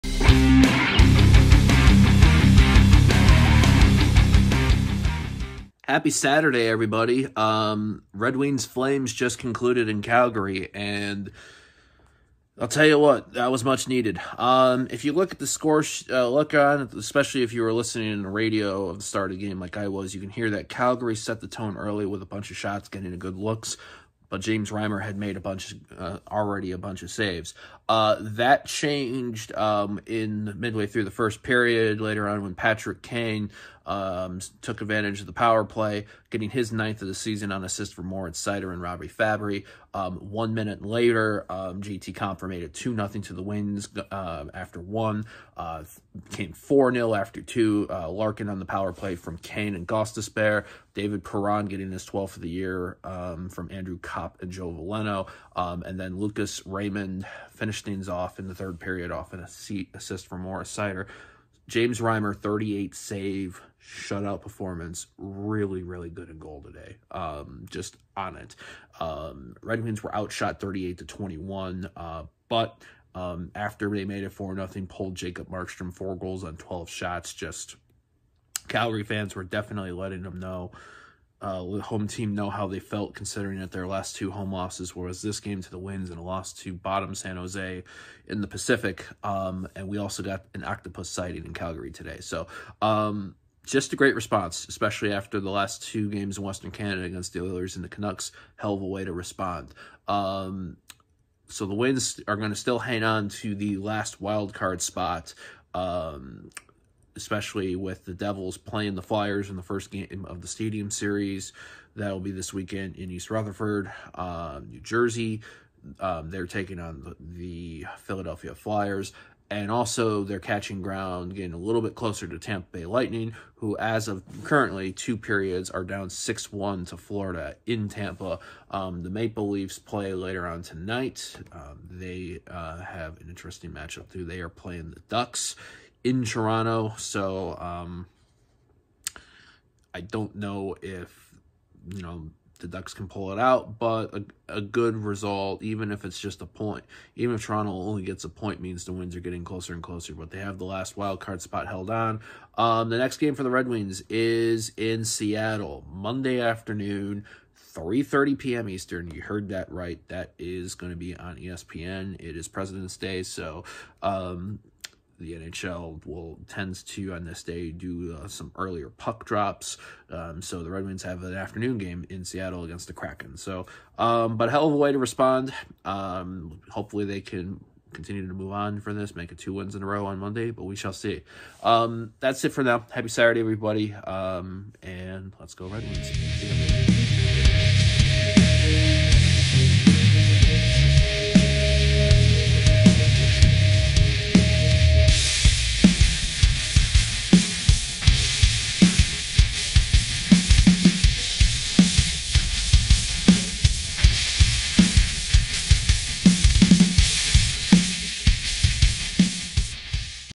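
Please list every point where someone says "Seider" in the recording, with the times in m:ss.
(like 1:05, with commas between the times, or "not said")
0:38, 1:00.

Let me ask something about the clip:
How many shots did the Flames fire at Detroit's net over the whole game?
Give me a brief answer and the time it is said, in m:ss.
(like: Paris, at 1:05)
38, at 1:10.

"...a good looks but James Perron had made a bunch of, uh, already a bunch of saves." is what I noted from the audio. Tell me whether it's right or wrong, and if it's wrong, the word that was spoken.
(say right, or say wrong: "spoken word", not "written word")
wrong: "Reimer", not "Perron".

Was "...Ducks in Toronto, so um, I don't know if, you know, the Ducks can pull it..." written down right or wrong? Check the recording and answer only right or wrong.
right.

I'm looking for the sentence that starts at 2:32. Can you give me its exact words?
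Um, the next game for the Red Wings is in Seattle Monday afternoon, three thirty p.m.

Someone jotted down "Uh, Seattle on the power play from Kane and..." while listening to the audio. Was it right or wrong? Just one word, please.
wrong.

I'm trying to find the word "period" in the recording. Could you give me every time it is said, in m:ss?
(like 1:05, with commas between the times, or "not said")
0:31, 0:58, 2:05.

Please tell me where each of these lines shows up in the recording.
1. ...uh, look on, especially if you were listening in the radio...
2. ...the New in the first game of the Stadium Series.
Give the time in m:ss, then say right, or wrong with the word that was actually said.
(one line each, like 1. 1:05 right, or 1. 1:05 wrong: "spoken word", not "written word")
1. 0:16 right
2. 1:48 wrong: "Flyers", not "New".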